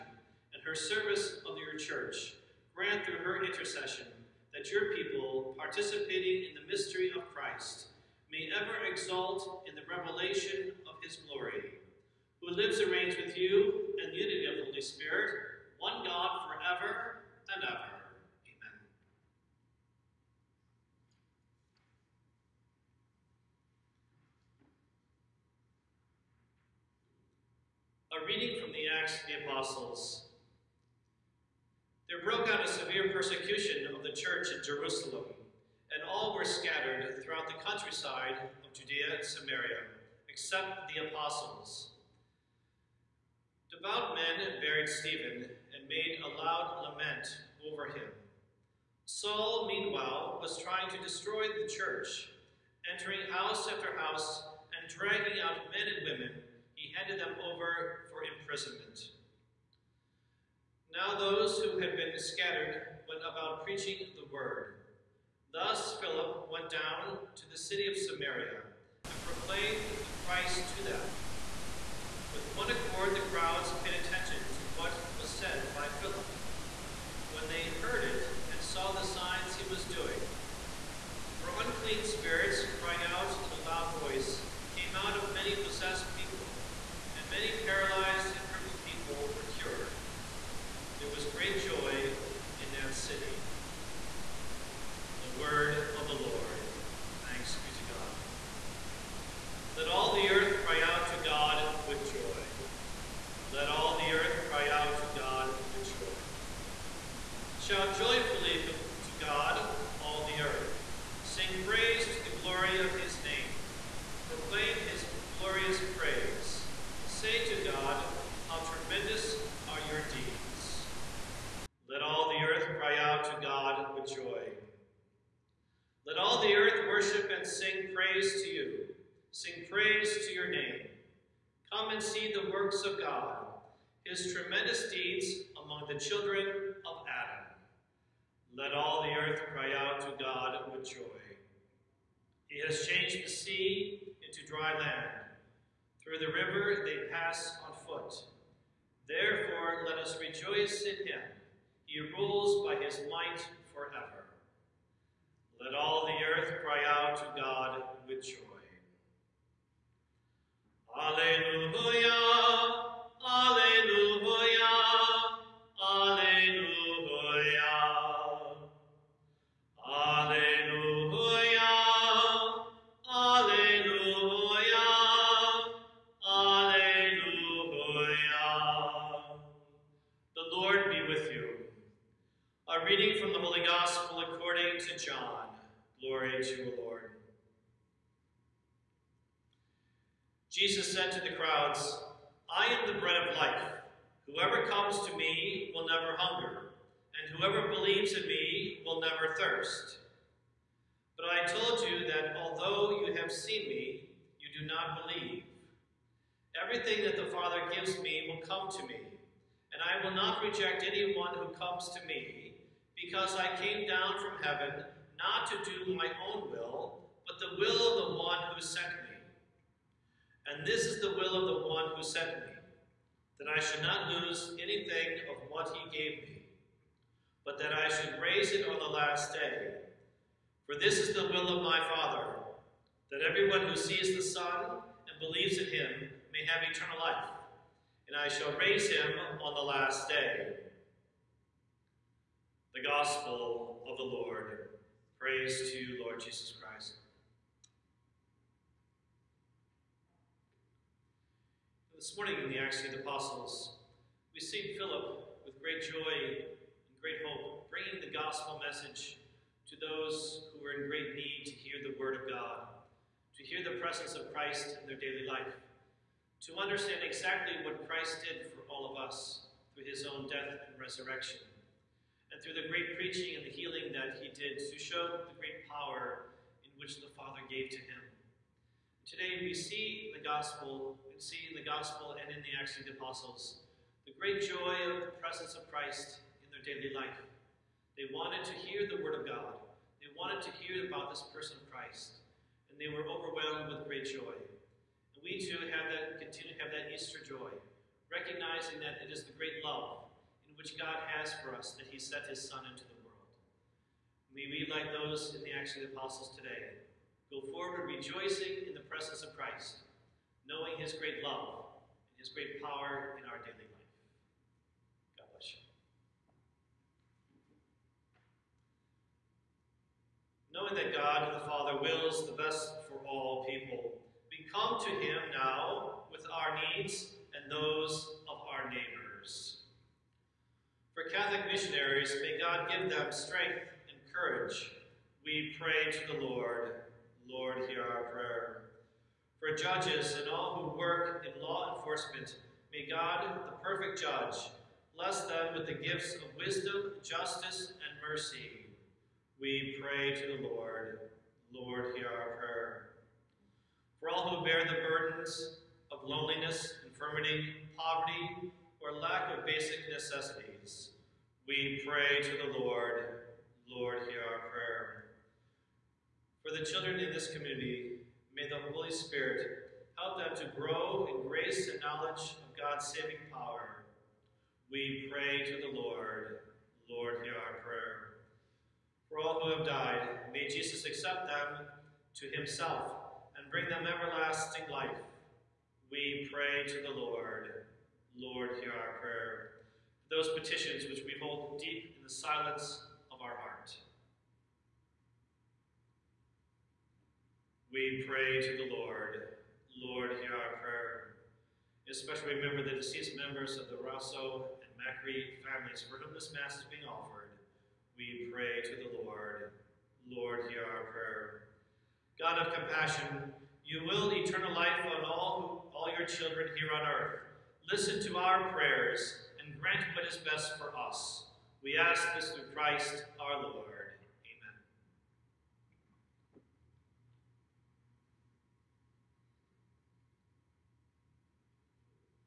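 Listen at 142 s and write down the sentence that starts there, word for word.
He has changed the sea into dry land.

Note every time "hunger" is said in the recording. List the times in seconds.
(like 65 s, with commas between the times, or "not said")
196 s.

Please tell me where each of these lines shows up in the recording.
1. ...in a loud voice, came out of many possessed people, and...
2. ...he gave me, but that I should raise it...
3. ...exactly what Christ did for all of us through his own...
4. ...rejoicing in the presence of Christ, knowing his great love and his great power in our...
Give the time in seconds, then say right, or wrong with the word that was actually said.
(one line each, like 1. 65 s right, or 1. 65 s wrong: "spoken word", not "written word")
1. 83 s right
2. 225 s right
3. 266 s right
4. 307 s right.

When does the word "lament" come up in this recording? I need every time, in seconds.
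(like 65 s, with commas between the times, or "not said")
46 s.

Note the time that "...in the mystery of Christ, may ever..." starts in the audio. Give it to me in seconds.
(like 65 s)
6 s.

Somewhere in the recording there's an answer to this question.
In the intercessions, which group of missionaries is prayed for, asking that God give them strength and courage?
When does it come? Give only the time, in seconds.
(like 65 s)
331 s.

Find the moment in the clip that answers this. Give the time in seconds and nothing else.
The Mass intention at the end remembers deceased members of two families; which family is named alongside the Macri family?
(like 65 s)
403 s.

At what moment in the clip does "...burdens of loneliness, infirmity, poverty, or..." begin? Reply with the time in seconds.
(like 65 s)
354 s.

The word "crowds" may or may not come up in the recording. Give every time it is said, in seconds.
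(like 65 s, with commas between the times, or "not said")
73 s, 191 s.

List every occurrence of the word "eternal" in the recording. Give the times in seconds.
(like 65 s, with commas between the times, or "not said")
236 s, 414 s.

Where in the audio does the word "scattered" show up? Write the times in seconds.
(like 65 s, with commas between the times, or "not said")
36 s, 62 s.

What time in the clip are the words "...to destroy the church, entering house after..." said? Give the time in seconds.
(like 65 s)
50 s.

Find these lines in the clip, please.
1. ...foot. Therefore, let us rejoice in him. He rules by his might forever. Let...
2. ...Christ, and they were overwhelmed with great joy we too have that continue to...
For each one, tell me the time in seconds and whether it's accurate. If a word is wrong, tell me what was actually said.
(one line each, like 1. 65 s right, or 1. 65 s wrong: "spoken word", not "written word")
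1. 147 s right
2. 291 s right.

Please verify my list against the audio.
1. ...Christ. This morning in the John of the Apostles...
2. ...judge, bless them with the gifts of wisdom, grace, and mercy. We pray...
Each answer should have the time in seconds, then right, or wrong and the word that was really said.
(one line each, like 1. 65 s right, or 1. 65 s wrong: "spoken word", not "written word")
1. 246 s wrong: "Acts", not "John"
2. 343 s wrong: "justice", not "grace".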